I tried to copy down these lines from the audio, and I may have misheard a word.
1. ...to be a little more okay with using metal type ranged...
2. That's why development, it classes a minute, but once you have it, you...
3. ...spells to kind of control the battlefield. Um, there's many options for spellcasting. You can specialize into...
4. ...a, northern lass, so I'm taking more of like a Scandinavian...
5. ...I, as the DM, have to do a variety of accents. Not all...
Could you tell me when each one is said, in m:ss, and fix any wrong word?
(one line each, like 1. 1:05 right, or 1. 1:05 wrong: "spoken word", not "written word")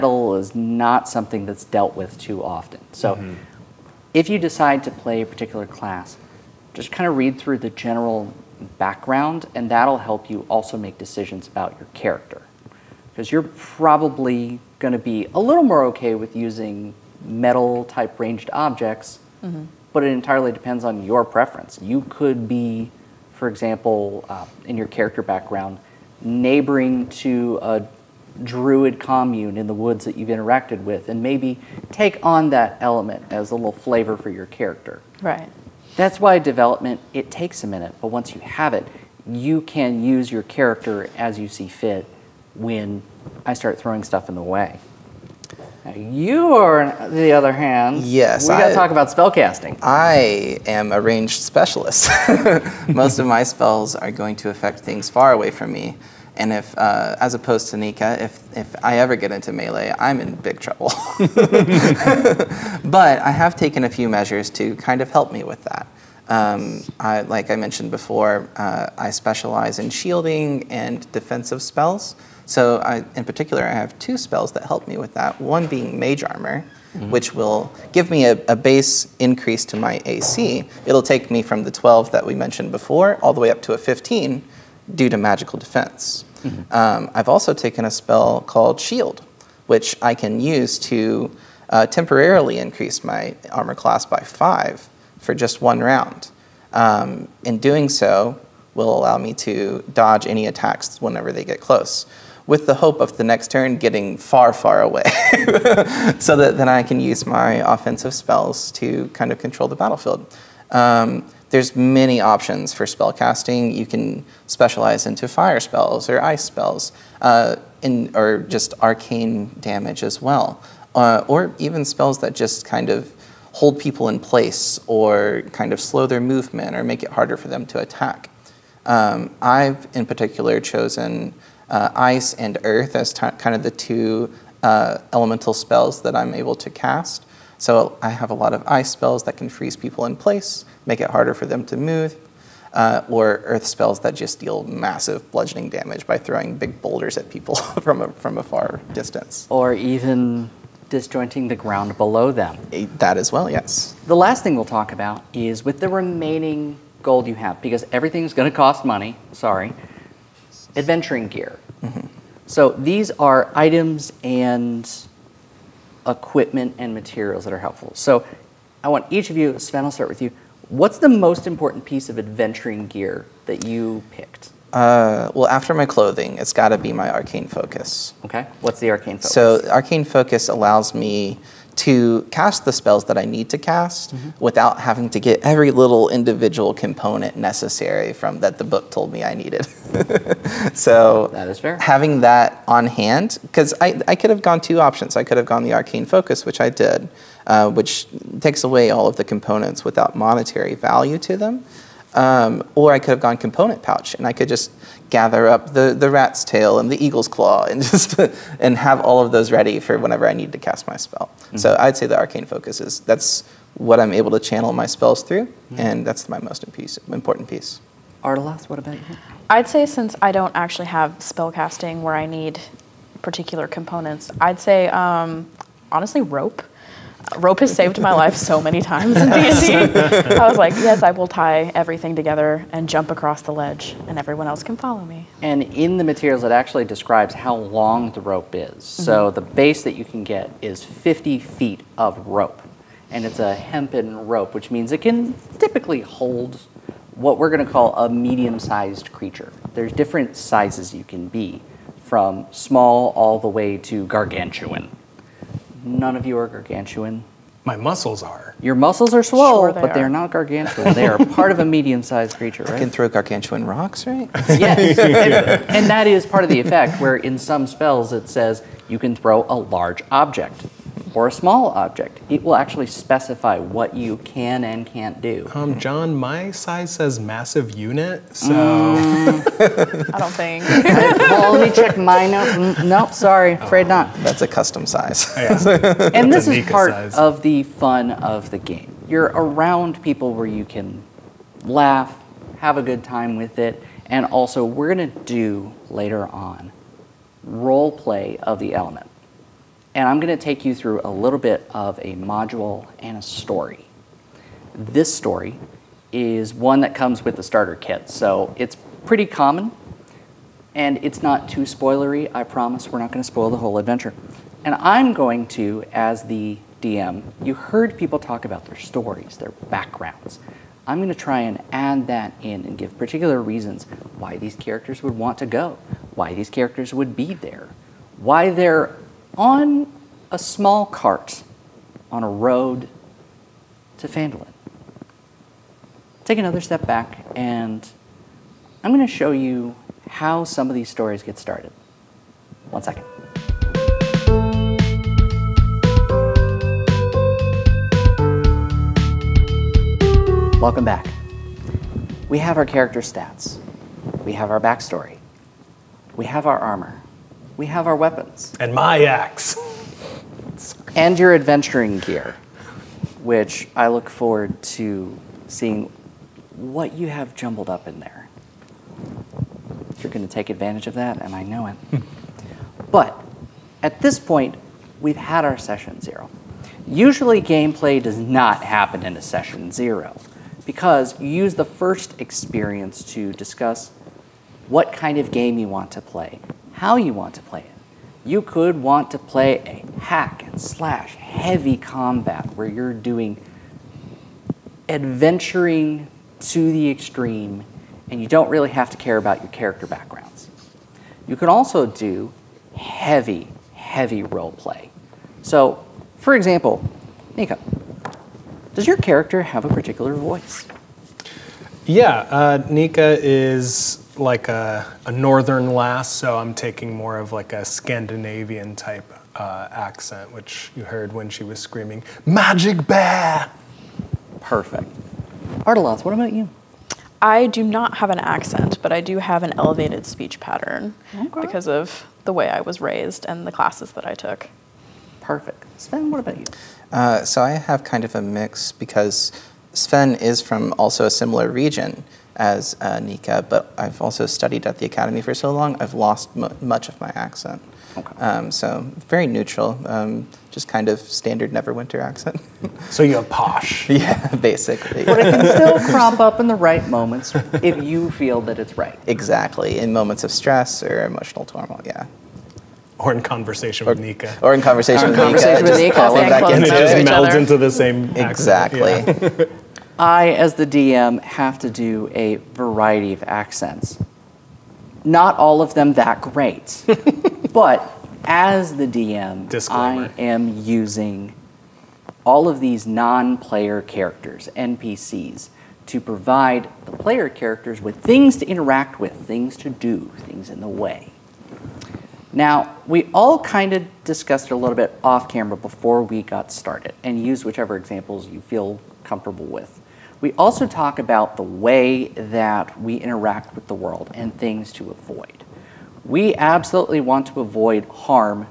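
1. 0:14 right
2. 0:35 wrong: "takes", not "classes"
3. 1:48 right
4. 6:55 right
5. 7:49 right.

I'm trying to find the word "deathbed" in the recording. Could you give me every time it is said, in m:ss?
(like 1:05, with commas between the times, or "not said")
not said.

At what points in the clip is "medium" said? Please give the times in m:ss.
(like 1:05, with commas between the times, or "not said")
4:08, 4:21.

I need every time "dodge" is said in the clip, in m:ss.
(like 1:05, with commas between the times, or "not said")
1:39.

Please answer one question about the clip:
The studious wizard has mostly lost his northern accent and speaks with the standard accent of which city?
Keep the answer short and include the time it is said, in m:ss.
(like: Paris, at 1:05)
Neverwinter, at 7:31.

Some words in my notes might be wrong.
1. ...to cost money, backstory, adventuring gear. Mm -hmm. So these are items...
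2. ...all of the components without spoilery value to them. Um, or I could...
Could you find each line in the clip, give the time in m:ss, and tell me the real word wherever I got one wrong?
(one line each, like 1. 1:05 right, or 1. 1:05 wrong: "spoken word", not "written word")
1. 2:38 wrong: "sorry", not "backstory"
2. 3:18 wrong: "monetary", not "spoilery".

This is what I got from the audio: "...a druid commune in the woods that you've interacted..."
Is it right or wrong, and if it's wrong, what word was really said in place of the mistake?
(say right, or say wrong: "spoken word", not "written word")
right.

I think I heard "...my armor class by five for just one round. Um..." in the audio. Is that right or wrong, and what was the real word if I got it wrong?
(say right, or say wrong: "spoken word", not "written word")
right.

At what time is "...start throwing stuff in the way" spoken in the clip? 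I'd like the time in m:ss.
0:43.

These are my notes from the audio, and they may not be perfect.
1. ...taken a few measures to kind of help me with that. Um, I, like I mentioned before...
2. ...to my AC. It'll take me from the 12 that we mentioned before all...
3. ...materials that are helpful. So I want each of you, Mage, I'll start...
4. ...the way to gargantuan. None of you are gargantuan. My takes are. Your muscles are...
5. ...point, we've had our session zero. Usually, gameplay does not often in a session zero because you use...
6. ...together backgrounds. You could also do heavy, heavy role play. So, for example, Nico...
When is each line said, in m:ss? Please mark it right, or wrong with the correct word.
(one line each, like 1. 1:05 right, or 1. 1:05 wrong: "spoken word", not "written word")
1. 1:03 right
2. 1:19 right
3. 2:46 wrong: "Sven", not "Mage"
4. 4:13 wrong: "muscles", not "takes"
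5. 6:14 wrong: "happen", not "often"
6. 6:39 wrong: "character", not "together".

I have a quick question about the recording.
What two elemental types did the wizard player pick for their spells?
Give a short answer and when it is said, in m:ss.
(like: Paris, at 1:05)
ice and earth, at 2:11.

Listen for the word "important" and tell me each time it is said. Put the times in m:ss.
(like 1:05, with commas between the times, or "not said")
2:51, 3:37.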